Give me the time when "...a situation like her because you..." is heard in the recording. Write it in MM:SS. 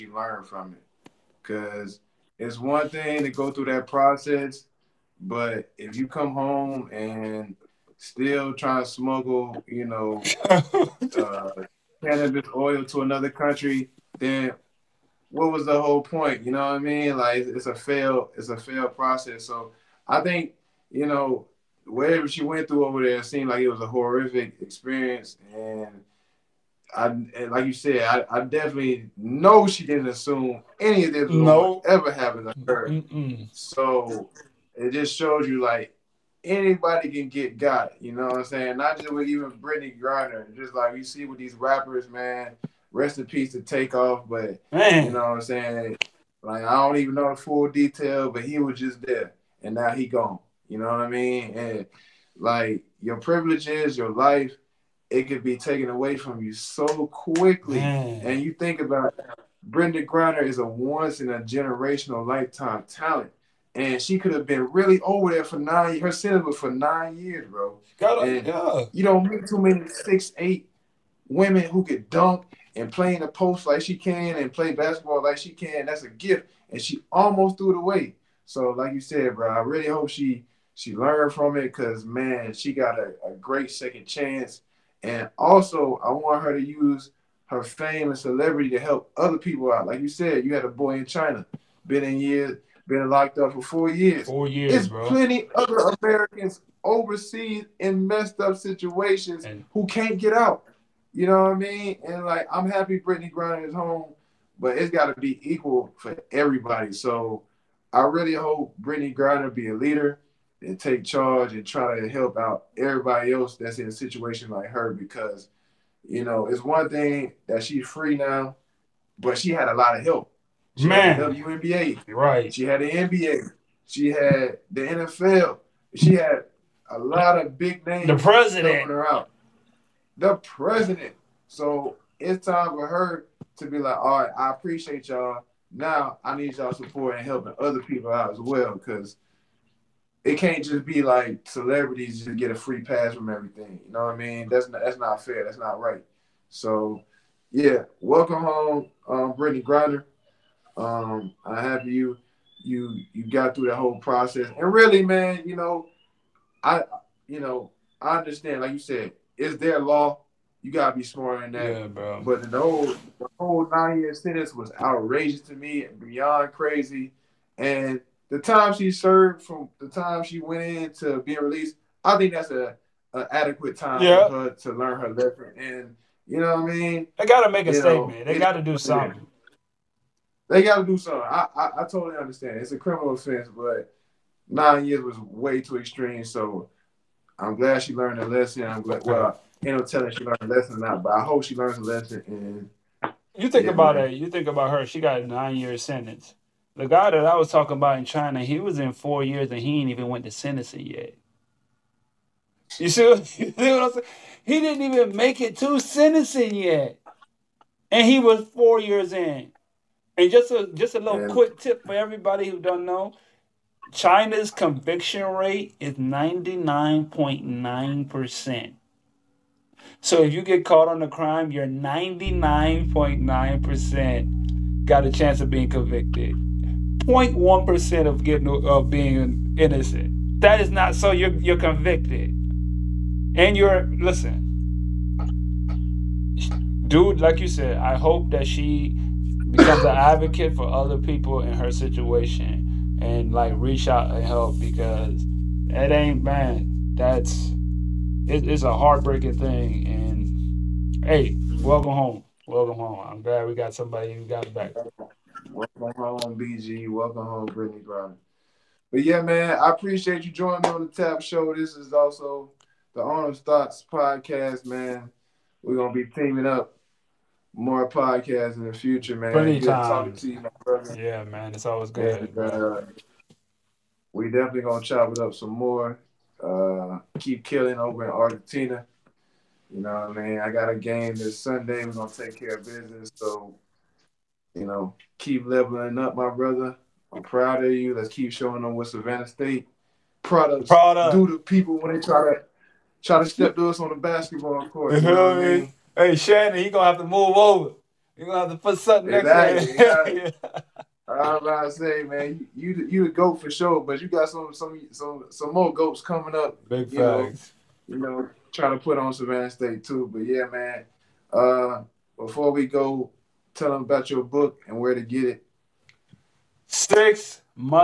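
01:53.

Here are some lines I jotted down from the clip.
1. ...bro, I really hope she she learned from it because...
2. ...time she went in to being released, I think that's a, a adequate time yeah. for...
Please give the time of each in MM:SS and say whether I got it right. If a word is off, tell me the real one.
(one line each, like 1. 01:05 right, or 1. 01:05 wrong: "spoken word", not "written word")
1. 01:19 right
2. 02:49 right.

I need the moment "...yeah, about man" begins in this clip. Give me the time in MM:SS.
03:13.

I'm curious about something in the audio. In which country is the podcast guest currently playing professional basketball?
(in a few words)
Argentina.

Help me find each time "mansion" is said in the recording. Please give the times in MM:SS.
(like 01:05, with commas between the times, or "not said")
not said.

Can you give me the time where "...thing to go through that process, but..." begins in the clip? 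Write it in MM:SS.
00:02.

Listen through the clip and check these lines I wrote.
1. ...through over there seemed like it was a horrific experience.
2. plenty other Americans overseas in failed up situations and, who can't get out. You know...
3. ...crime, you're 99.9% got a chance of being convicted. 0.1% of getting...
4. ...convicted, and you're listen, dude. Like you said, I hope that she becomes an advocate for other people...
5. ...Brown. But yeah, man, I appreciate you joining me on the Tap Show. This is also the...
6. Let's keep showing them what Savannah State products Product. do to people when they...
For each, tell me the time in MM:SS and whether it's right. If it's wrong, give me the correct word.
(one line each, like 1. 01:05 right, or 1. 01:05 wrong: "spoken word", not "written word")
1. 00:22 right
2. 01:35 wrong: "messed", not "failed"
3. 03:41 right
4. 03:51 right
5. 04:17 right
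6. 04:47 right.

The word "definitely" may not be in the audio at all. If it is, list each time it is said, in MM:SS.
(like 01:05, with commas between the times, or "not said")
00:28, 04:34.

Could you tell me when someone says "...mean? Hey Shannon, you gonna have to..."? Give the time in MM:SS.
04:55.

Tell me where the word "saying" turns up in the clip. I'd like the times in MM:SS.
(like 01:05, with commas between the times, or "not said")
00:38, 00:45, 03:23.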